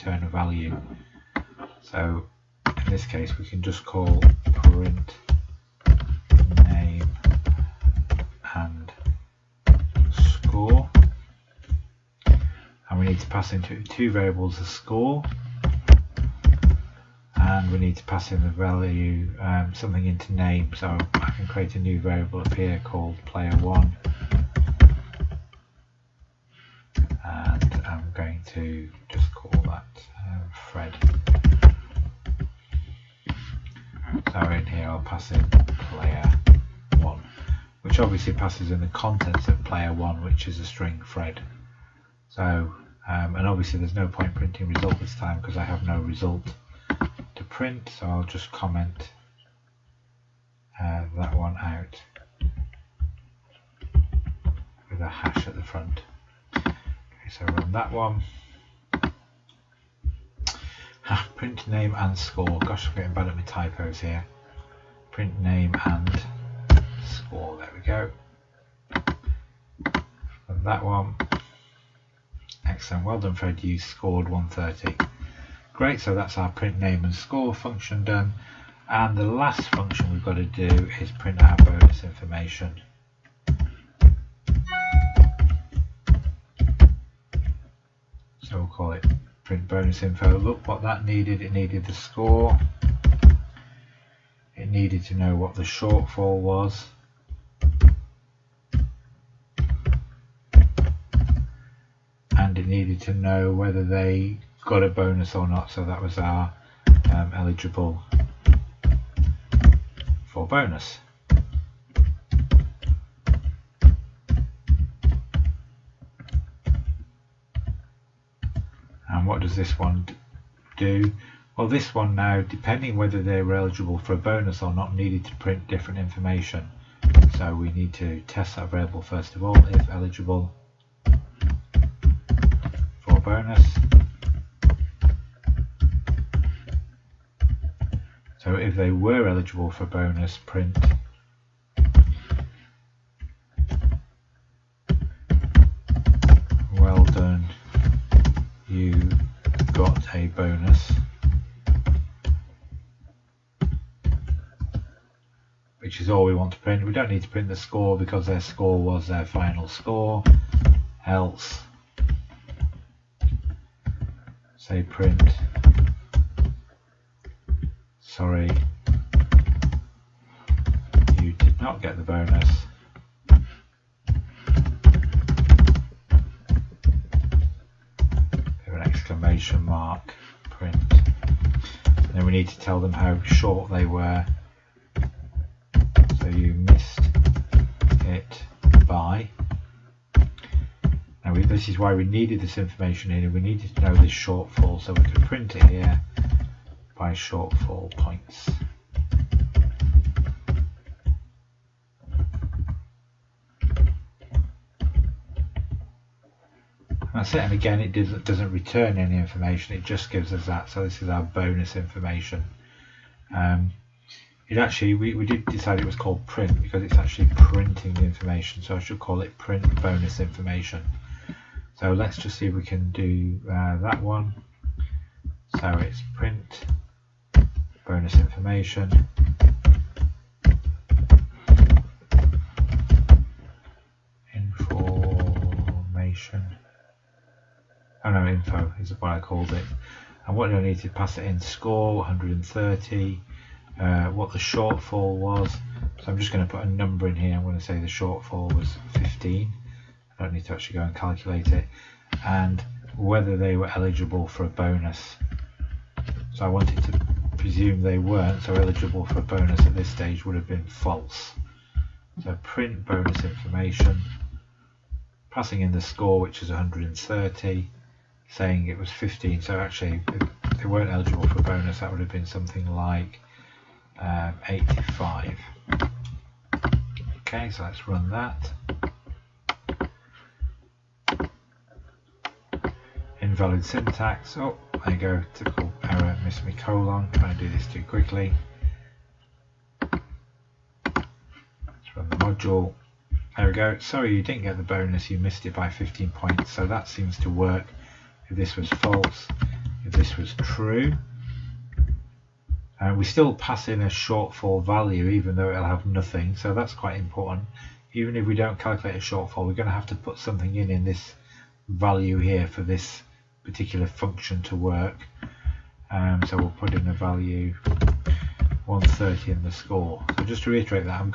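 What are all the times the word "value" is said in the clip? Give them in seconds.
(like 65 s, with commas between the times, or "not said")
0 s, 18 s, 304 s, 311 s, 316 s.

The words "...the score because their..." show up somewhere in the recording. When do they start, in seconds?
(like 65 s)
157 s.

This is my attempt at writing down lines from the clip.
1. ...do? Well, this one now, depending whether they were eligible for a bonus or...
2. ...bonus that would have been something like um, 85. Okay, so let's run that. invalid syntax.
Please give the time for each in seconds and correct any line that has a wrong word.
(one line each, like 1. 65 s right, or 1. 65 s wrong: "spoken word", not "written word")
1. 120 s right
2. 271 s right.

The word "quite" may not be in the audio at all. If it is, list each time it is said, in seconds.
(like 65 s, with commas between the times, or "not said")
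306 s.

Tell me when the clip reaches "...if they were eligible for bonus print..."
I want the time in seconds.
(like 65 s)
138 s.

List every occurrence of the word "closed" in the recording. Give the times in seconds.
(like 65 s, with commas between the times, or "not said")
not said.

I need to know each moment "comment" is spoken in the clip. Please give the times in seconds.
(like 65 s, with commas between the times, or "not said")
48 s.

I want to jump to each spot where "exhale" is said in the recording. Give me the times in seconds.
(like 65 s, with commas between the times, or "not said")
not said.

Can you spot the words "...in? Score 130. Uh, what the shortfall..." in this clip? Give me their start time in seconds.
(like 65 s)
241 s.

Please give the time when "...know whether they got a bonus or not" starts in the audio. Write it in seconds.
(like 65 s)
103 s.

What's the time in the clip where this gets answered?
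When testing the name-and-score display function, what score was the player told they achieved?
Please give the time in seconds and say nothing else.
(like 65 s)
73 s.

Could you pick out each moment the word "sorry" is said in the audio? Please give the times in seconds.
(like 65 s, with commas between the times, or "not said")
167 s, 293 s.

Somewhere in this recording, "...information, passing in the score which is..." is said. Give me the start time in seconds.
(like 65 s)
263 s.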